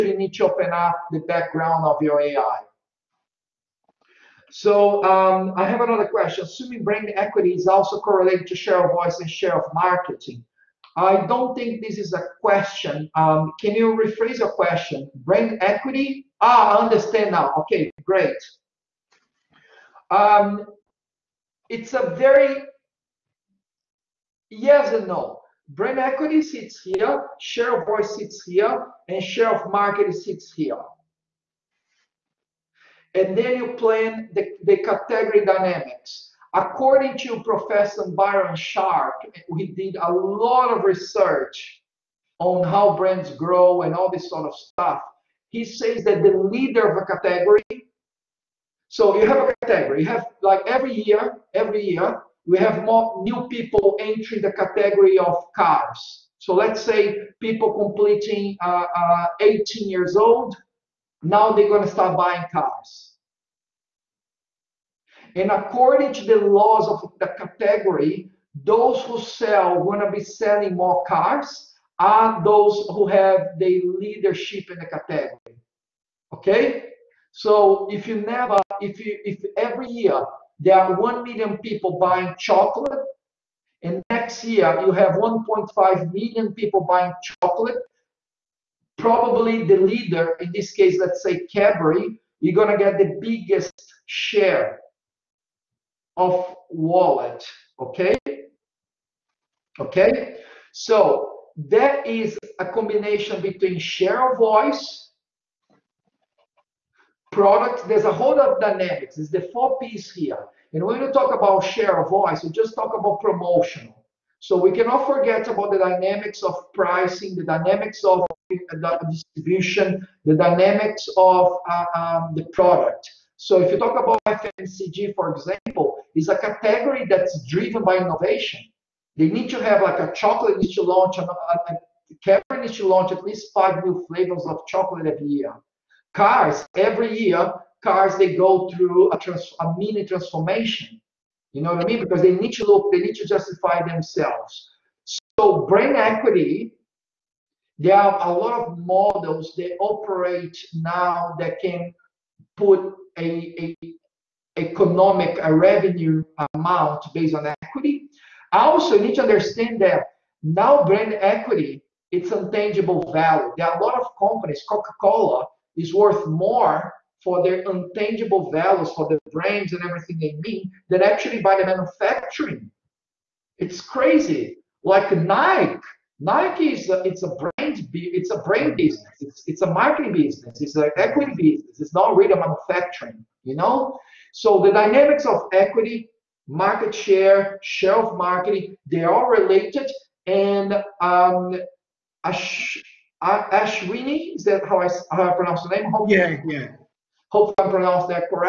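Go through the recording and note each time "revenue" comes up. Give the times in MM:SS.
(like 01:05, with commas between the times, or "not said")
02:35.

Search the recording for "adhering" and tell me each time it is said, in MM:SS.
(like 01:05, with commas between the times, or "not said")
not said.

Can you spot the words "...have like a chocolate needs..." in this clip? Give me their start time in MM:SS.
02:09.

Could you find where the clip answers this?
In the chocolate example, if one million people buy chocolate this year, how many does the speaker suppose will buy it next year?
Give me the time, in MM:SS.
01:25.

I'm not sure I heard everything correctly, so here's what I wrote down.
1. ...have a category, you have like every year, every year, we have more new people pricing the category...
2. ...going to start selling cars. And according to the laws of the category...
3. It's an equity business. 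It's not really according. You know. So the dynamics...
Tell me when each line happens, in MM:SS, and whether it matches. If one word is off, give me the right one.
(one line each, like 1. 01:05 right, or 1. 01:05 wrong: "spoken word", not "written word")
1. 00:49 wrong: "entering", not "pricing"
2. 01:01 wrong: "buying", not "selling"
3. 03:00 wrong: "manufacturing", not "according".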